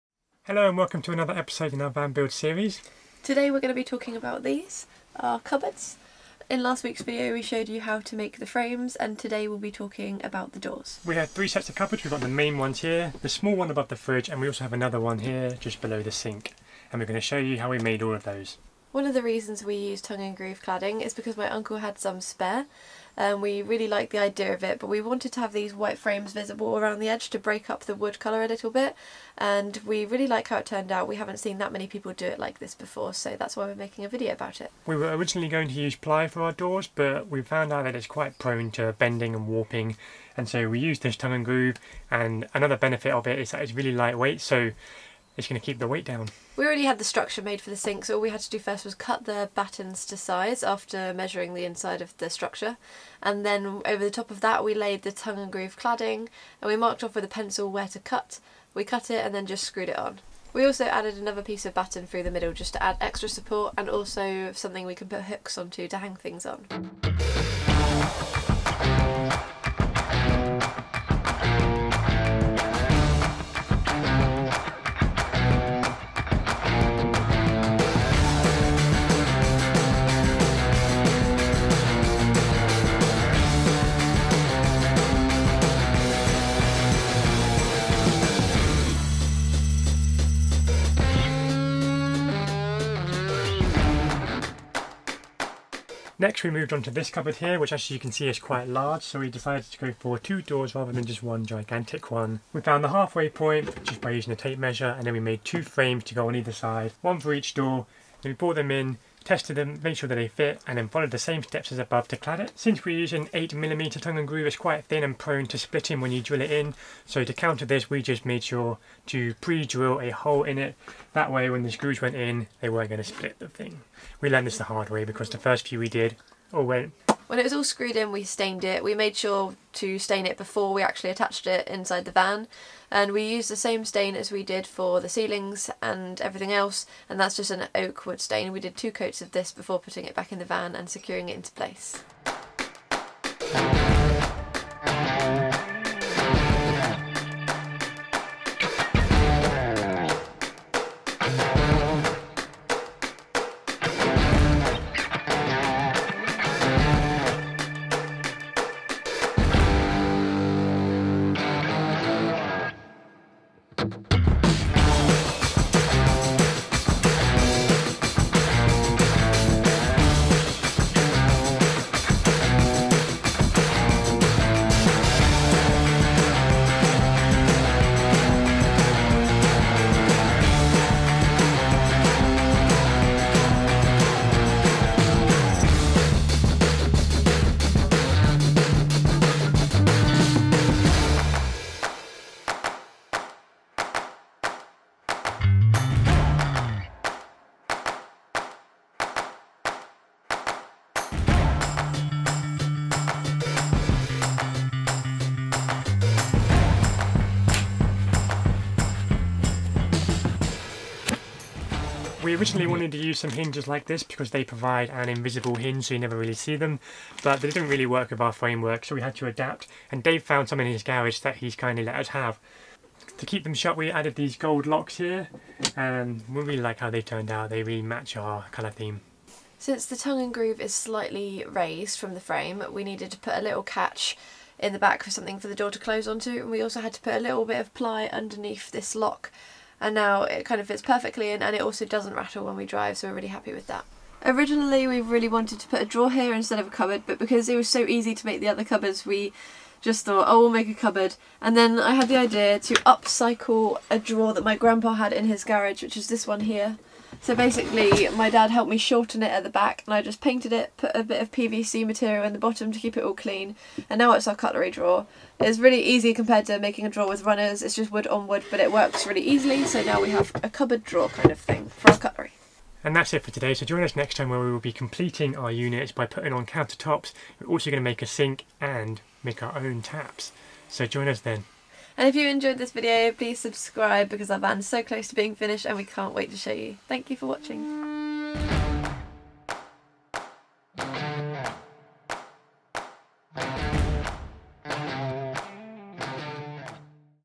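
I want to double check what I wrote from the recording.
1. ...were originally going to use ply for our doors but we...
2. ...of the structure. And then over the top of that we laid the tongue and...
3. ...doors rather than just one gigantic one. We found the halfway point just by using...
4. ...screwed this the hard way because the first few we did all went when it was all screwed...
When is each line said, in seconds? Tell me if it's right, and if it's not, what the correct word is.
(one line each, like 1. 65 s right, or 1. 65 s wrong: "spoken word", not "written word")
1. 34 s right
2. 52 s right
3. 100 s right
4. 124 s wrong: "learned", not "screwed".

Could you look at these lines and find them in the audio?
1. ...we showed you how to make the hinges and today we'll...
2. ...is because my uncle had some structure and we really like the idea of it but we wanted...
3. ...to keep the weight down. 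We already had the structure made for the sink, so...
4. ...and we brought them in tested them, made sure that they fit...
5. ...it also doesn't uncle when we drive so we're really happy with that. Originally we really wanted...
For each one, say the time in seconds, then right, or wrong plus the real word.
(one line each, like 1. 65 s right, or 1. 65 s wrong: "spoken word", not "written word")
1. 7 s wrong: "frames", not "hinges"
2. 21 s wrong: "spare", not "structure"
3. 45 s right
4. 108 s right
5. 241 s wrong: "rattle", not "uncle".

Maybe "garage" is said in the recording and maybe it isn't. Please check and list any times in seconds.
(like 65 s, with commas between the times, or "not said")
220 s, 255 s.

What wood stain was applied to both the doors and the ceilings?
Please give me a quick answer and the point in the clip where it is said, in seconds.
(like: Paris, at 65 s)
oak wood stain, at 137 s.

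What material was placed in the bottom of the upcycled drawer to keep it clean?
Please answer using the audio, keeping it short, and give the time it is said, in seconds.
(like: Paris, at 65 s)
PVC, at 261 s.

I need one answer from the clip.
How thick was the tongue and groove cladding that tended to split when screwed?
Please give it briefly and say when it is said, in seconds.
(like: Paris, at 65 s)
8mm, at 113 s.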